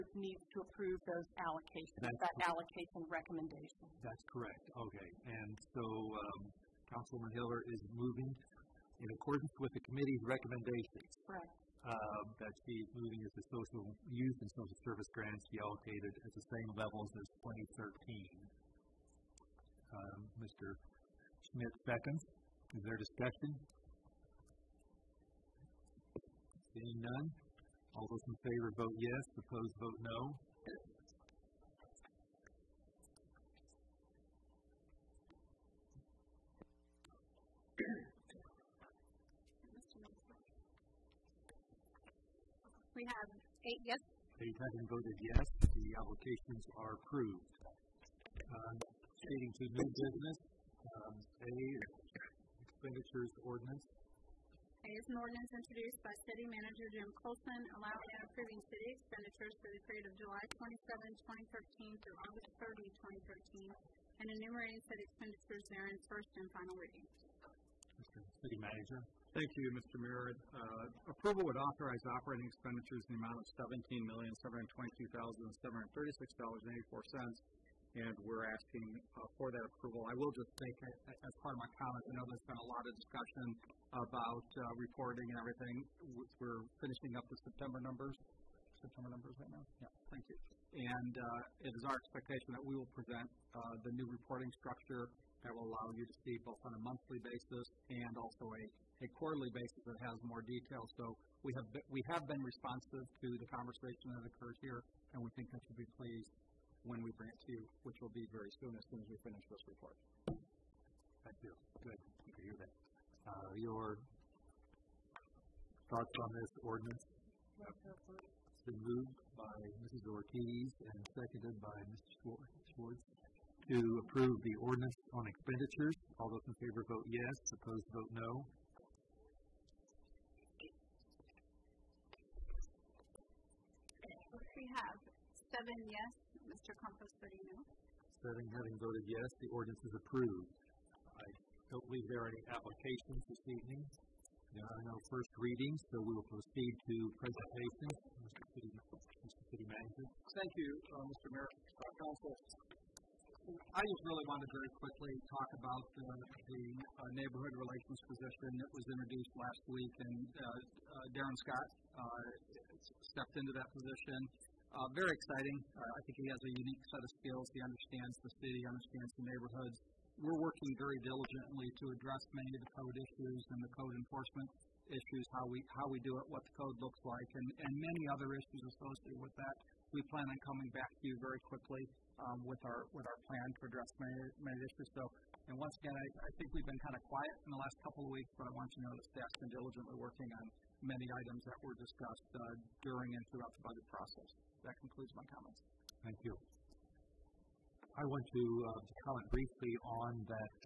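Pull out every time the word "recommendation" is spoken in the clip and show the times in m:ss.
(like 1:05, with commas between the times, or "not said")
0:03, 0:10.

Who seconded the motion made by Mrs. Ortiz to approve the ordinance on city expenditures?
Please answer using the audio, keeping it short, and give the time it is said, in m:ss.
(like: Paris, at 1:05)
Mr. Schwartz, at 2:01.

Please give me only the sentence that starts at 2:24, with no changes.
There are no first readings, so we will proceed to presentations.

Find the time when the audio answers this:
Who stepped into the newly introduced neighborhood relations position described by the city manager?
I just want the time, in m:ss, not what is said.
2:41.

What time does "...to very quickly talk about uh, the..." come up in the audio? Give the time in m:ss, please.
2:34.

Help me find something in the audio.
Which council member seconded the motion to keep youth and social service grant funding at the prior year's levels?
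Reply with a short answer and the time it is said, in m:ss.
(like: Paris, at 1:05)
Mr. Schmidt, at 0:20.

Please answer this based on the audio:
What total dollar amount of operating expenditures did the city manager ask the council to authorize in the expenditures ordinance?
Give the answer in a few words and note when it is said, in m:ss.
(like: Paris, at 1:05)
$17,722,736.84, at 1:13.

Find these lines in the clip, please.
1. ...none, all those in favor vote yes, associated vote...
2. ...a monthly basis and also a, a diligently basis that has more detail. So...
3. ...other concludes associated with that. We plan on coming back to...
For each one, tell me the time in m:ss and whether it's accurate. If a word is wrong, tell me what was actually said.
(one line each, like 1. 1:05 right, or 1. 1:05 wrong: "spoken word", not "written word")
1. 0:27 wrong: "opposed", not "associated"
2. 1:36 wrong: "quarterly", not "diligently"
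3. 2:58 wrong: "issues", not "concludes".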